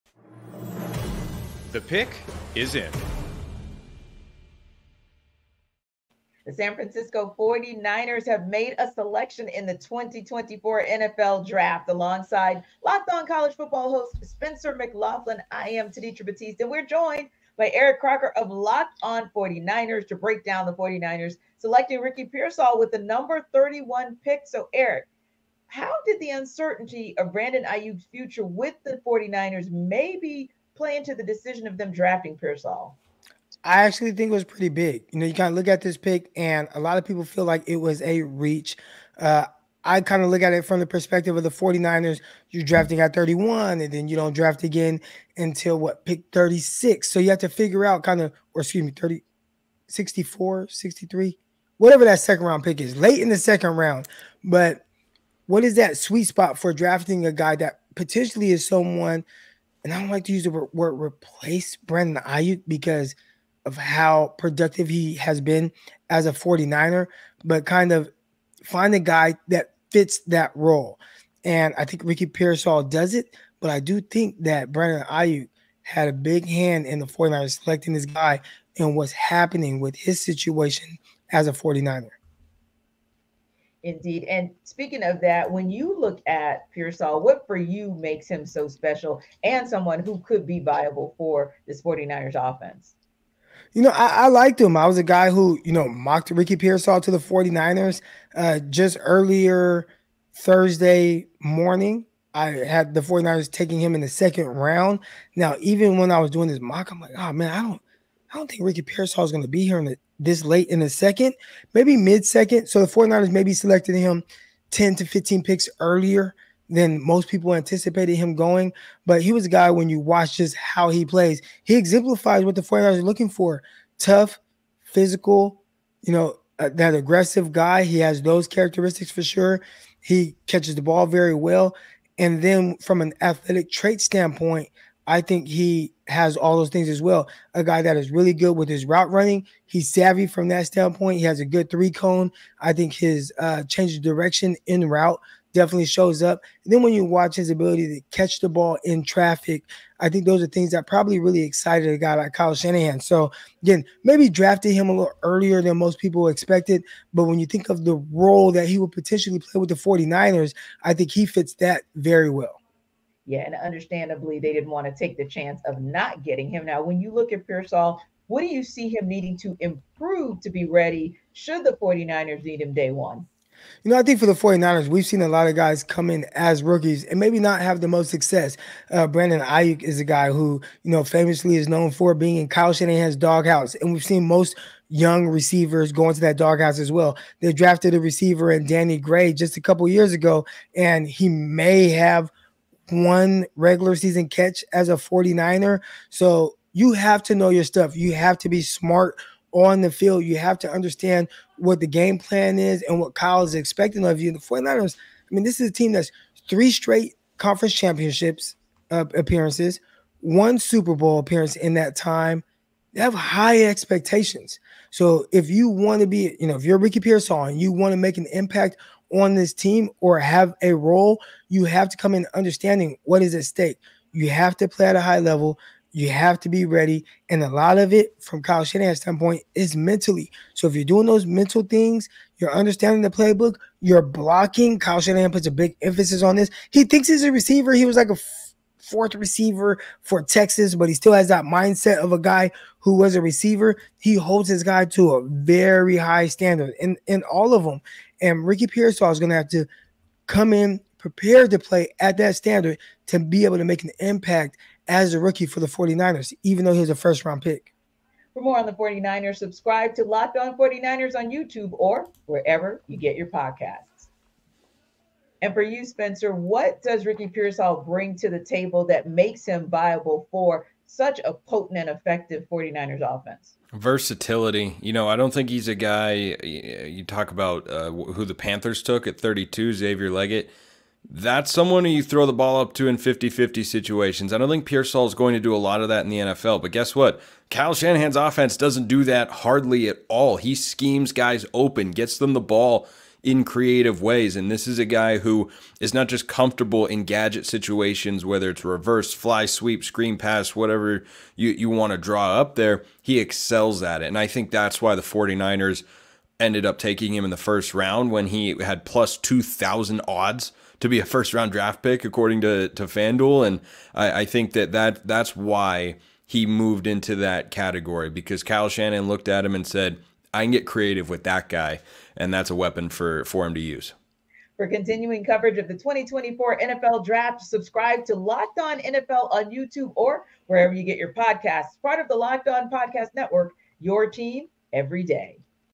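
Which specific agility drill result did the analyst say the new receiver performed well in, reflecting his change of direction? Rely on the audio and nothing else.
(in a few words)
three cone.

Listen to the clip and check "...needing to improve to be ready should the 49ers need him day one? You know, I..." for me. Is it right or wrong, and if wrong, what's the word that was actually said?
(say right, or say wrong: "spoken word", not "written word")
right.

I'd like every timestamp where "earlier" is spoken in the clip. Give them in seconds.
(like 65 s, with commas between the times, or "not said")
98 s, 115 s, 155 s.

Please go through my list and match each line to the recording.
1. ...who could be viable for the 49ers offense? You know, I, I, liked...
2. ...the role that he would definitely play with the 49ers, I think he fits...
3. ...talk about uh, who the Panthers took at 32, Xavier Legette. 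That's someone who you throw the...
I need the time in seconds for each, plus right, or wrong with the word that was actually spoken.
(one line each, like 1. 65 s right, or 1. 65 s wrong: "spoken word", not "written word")
1. 90 s right
2. 157 s wrong: "potentially", not "definitely"
3. 277 s right.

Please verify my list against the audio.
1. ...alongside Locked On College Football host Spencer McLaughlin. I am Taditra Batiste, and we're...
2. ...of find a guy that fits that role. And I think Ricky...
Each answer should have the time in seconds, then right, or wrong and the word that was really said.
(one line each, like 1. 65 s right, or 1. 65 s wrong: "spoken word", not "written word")
1. 11 s right
2. 67 s right.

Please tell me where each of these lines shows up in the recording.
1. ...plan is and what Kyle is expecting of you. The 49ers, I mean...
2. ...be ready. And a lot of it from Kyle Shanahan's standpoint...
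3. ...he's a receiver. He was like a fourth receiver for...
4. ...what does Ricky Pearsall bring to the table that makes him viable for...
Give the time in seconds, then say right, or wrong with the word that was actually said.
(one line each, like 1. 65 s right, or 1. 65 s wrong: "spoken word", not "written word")
1. 202 s right
2. 226 s right
3. 237 s right
4. 266 s right.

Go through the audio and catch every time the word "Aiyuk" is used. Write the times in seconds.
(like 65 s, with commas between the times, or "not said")
27 s, 62 s, 75 s, 179 s.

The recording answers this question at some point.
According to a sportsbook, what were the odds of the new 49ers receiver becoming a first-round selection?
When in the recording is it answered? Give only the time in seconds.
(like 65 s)
308 s.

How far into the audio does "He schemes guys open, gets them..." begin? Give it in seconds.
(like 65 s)
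290 s.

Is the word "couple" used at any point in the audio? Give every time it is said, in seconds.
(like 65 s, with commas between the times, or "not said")
189 s.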